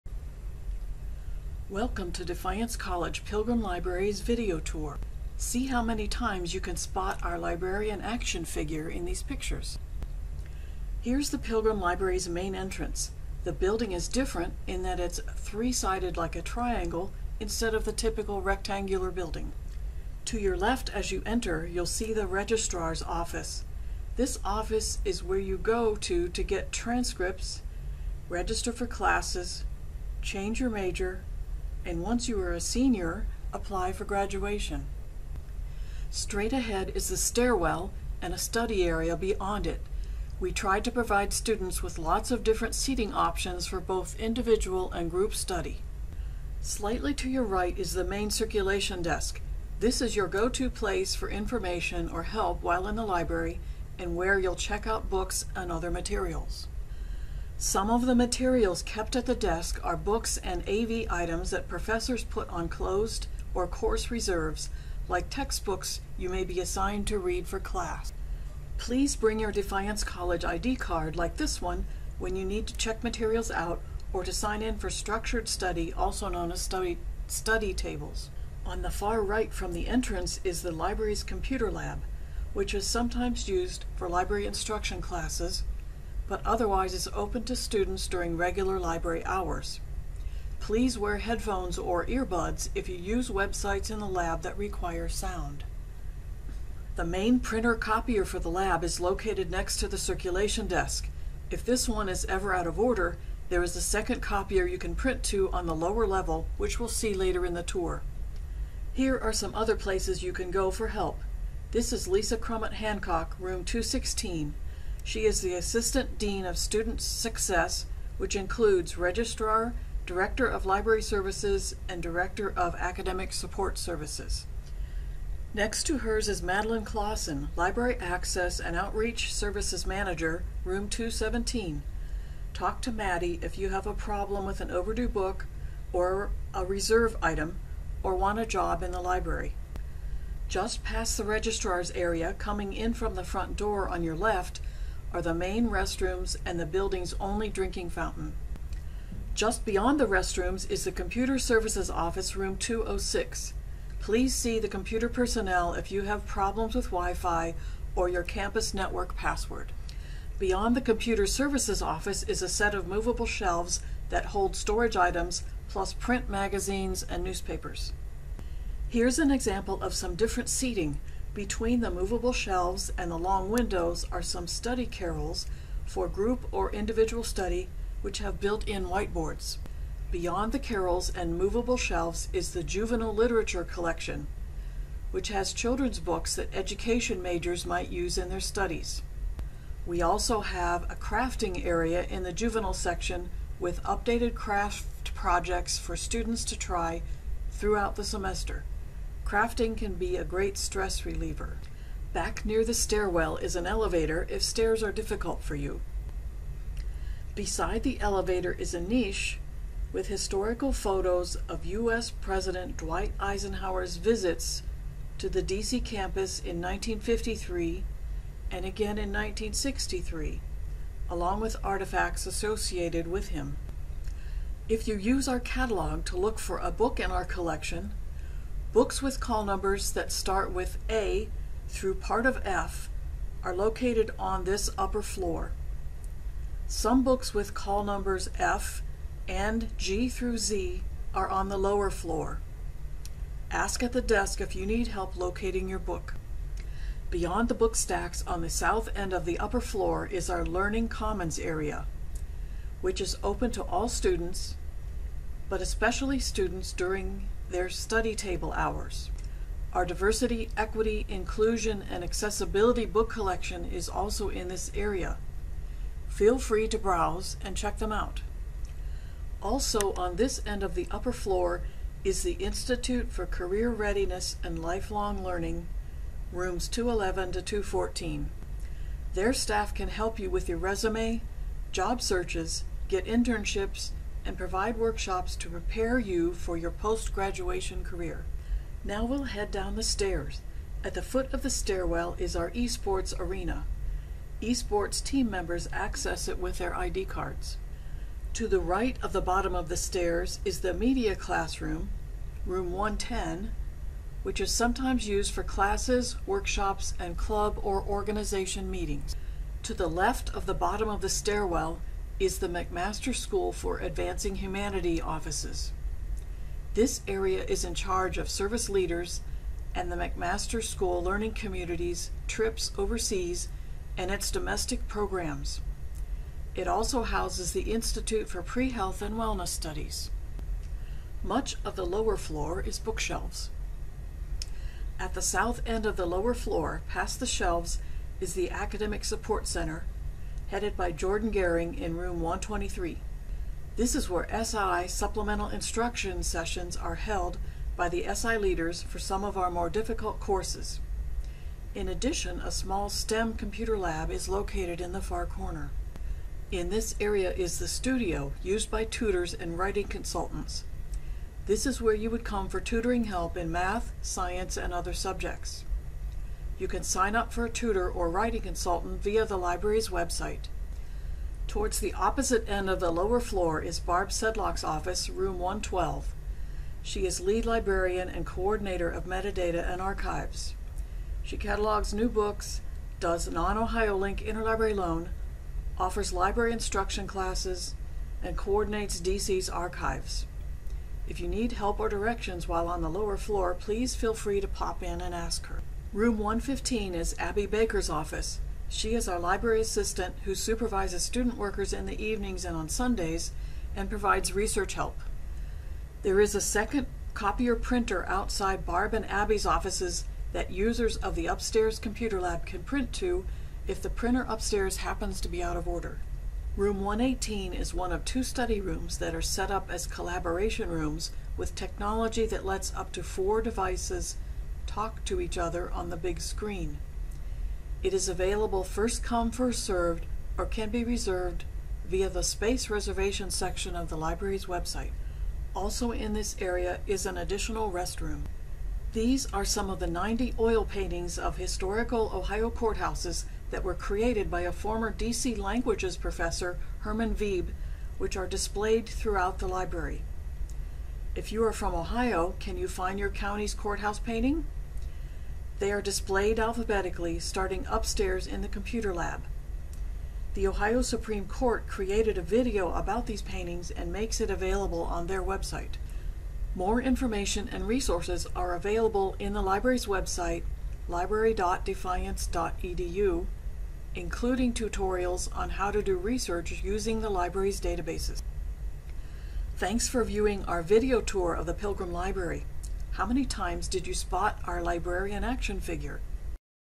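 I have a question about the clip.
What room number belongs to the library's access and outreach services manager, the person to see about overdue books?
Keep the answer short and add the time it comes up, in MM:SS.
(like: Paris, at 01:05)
217, at 02:10.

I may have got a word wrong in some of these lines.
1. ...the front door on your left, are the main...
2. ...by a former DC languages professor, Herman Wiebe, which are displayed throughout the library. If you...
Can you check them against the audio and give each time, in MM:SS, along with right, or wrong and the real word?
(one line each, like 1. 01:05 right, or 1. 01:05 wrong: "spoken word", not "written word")
1. 02:23 right
2. 07:24 right.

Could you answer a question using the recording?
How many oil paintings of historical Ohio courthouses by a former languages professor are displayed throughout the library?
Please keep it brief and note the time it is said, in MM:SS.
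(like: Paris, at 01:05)
90, at 07:19.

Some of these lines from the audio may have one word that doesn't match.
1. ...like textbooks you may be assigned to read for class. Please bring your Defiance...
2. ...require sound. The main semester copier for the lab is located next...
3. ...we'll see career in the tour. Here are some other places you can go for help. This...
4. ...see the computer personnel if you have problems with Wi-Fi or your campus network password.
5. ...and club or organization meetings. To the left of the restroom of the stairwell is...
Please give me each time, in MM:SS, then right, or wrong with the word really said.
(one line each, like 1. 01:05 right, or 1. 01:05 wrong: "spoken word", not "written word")
1. 01:05 right
2. 01:34 wrong: "printer", not "semester"
3. 01:46 wrong: "later", not "career"
4. 02:34 right
5. 05:06 wrong: "bottom", not "restroom".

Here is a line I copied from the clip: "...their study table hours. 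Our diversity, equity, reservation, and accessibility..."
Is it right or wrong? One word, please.
wrong.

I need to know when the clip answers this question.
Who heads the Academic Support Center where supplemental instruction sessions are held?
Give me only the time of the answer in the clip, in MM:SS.
05:40.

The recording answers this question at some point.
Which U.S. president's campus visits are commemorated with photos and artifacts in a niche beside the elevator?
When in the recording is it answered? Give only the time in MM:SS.
03:32.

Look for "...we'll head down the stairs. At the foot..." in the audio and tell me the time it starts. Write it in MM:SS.
04:49.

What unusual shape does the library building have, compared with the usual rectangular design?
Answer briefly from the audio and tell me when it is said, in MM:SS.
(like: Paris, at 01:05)
Triangle, at 00:15.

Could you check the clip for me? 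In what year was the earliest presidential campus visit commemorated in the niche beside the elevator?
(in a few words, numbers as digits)
1953.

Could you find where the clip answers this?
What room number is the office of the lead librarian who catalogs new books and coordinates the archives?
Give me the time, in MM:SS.
06:15.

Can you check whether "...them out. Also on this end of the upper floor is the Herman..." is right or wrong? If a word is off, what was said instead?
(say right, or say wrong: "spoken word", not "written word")
wrong: "Institute", not "Herman".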